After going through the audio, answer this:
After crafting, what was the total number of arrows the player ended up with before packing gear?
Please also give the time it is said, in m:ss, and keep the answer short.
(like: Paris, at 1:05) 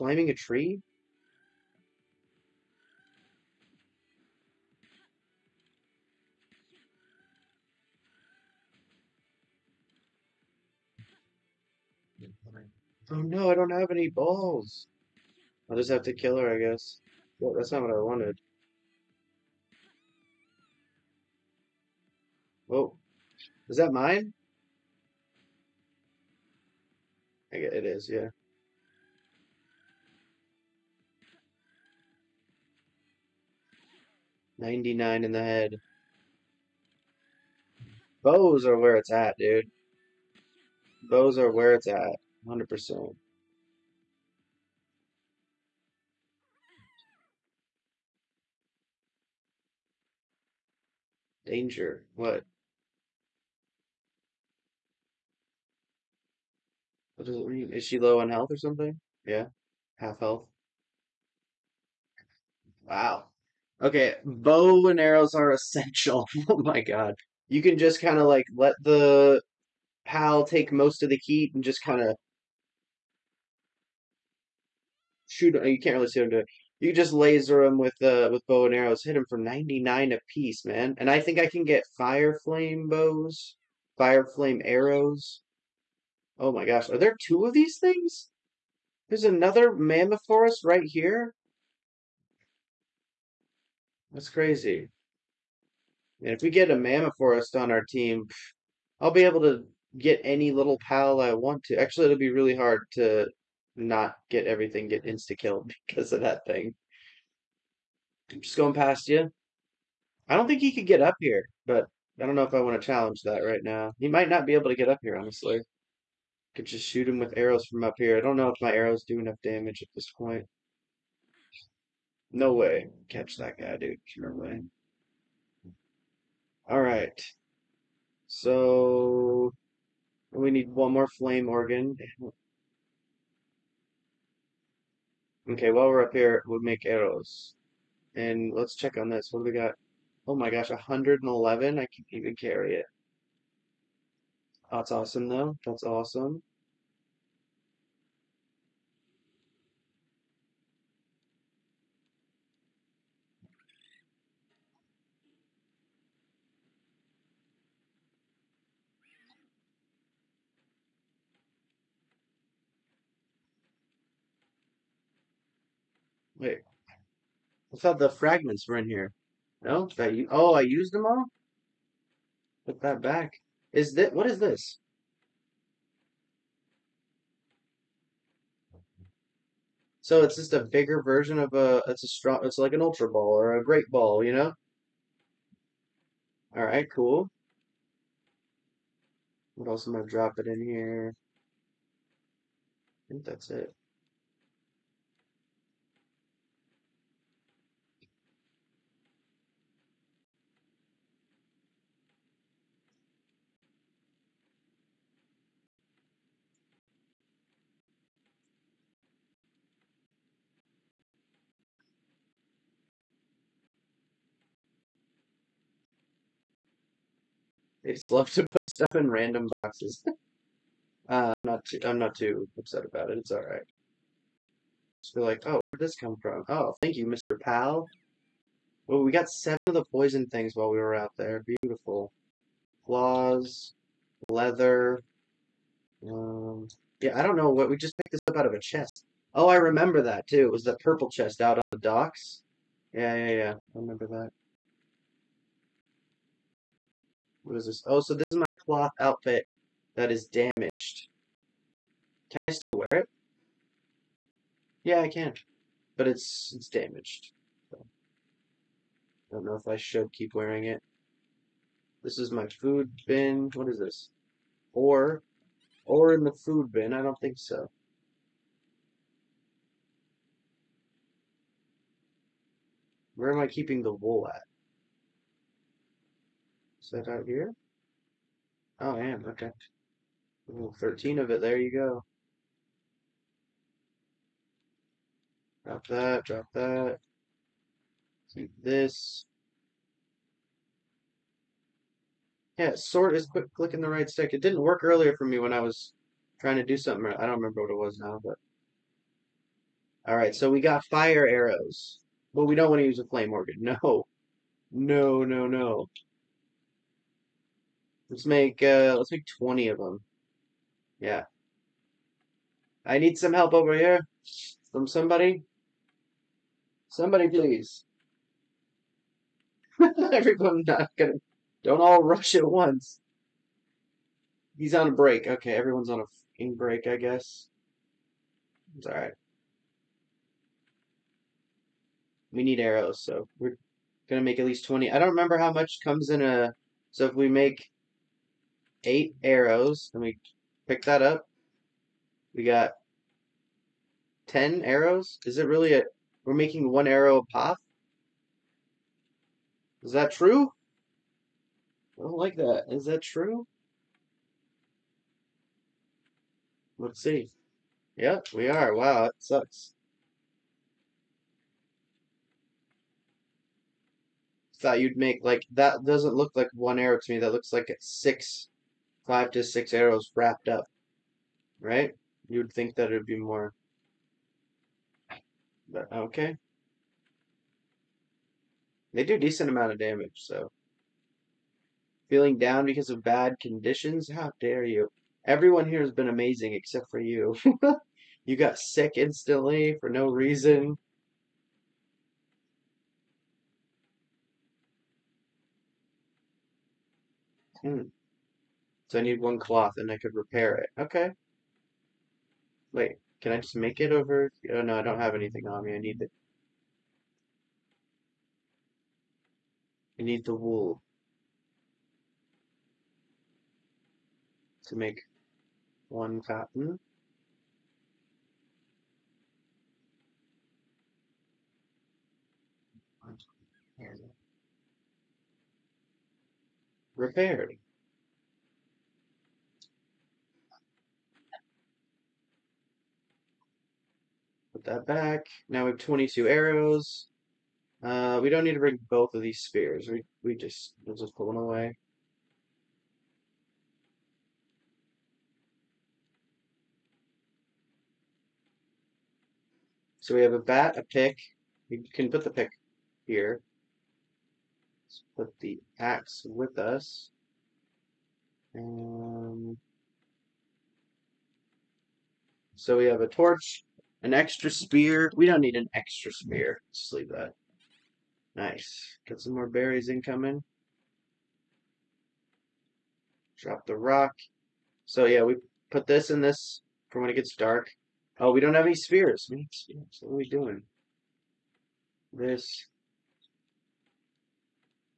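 22, at 7:15.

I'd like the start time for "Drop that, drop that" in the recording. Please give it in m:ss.
4:45.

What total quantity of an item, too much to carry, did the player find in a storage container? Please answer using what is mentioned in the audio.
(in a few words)
111.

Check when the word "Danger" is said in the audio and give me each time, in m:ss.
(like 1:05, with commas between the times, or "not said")
0:51.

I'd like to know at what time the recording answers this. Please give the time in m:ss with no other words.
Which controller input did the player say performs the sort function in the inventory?
4:53.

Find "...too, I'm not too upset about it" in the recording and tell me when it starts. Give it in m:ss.
3:41.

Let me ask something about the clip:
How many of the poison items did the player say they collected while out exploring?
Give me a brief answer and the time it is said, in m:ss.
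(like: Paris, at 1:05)
seven, at 3:49.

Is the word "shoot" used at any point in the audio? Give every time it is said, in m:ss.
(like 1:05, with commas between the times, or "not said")
1:15, 1:56.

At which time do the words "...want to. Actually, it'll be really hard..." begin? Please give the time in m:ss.
1:41.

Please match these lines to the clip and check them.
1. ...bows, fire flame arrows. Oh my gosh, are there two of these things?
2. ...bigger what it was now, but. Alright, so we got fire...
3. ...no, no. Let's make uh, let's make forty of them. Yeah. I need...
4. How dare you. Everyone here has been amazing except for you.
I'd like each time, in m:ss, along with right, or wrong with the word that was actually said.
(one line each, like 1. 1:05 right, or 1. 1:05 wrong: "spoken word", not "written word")
1. 1:22 right
2. 4:57 wrong: "remember", not "bigger"
3. 5:05 wrong: "twenty", not "forty"
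4. 6:24 right.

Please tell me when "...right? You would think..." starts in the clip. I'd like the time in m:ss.
6:11.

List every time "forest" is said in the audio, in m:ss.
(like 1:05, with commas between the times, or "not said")
1:30, 1:37.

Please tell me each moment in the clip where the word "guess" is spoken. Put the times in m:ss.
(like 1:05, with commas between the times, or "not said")
0:16, 5:26.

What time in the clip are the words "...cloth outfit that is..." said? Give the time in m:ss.
4:08.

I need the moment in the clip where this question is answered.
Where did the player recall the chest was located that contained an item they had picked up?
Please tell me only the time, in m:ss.
4:01.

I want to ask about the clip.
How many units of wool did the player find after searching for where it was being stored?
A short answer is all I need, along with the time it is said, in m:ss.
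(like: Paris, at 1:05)
13, at 4:40.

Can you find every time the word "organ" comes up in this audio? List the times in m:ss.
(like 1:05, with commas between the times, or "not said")
2:11, 5:03.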